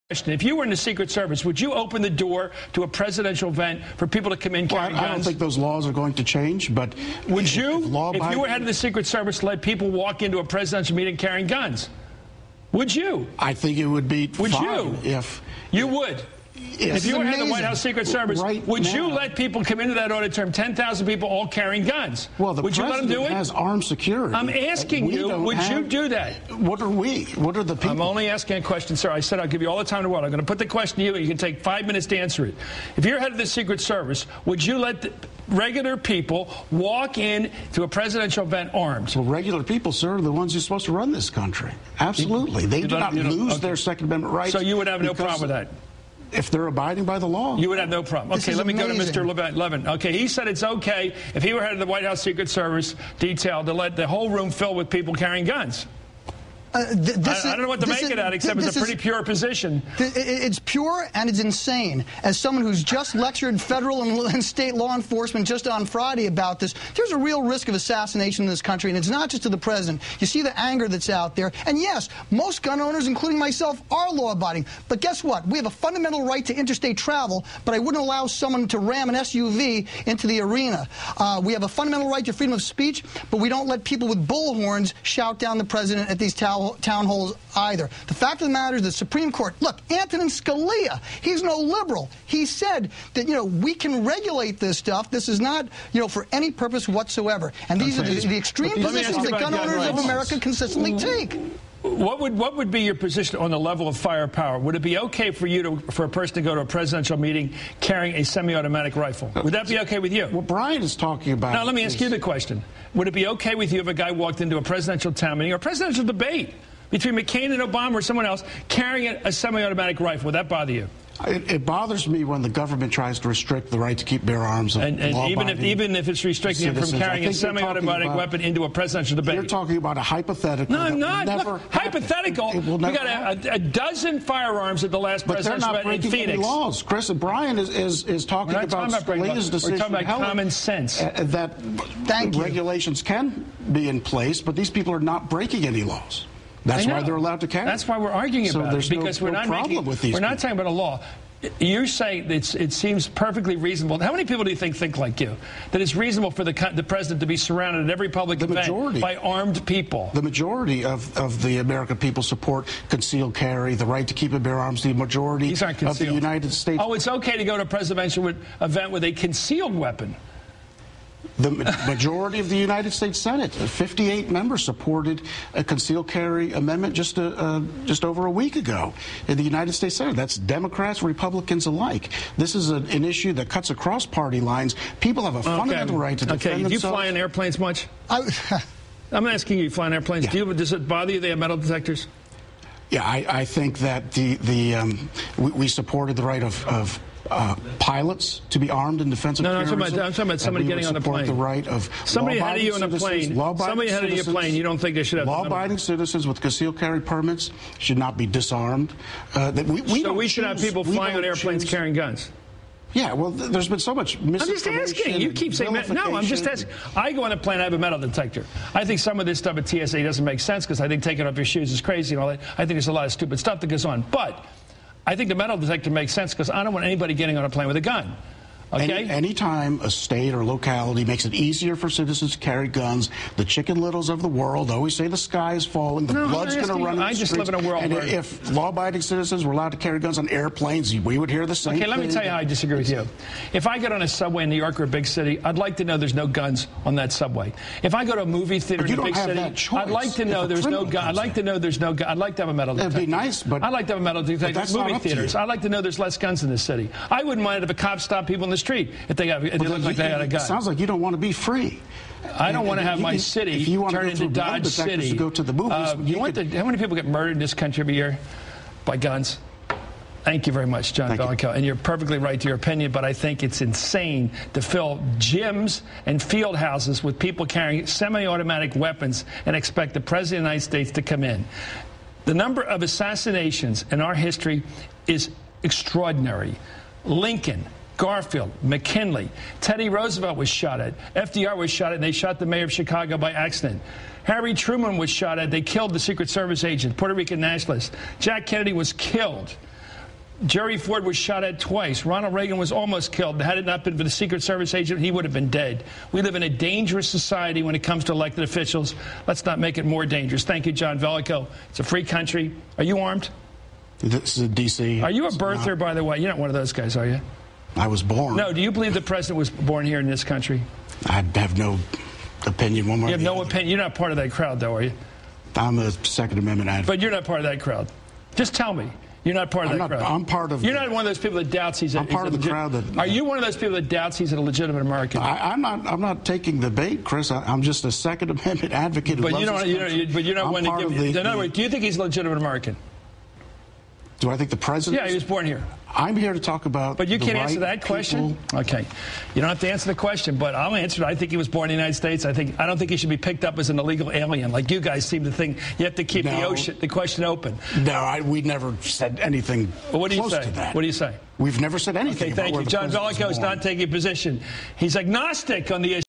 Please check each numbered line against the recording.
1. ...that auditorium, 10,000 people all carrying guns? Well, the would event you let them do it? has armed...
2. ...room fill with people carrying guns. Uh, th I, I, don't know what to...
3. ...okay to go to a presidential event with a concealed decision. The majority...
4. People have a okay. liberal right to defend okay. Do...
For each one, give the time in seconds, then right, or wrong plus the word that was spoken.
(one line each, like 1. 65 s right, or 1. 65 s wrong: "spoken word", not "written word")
1. 19 s wrong: "president", not "event"
2. 54 s right
3. 167 s wrong: "weapon", not "decision"
4. 184 s wrong: "fundamental", not "liberal".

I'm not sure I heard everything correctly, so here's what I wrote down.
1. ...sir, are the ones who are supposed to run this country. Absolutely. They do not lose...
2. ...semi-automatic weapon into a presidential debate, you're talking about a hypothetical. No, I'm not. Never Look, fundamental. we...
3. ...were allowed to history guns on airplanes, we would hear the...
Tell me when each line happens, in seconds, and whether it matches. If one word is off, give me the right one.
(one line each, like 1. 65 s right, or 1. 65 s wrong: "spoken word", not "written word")
1. 39 s right
2. 127 s wrong: "hypothetical", not "fundamental"
3. 239 s wrong: "carry", not "history".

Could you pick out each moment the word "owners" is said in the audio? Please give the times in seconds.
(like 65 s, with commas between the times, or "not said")
72 s, 99 s.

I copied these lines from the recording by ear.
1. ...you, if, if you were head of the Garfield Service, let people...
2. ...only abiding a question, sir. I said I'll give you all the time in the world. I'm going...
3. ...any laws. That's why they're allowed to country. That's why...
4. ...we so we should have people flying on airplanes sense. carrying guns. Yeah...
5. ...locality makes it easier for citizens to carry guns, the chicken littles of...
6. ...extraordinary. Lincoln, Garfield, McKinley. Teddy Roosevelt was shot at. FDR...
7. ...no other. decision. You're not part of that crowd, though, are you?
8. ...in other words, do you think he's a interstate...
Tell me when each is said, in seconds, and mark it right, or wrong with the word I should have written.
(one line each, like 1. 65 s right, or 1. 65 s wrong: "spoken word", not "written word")
1. 7 s wrong: "Secret", not "Garfield"
2. 28 s wrong: "asking", not "abiding"
3. 145 s wrong: "carry", not "country"
4. 209 s wrong: "choose", not "sense"
5. 230 s right
6. 285 s right
7. 323 s wrong: "opinion", not "decision"
8. 341 s wrong: "legitimate", not "interstate".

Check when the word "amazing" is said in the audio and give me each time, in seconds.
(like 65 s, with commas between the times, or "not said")
17 s, 48 s.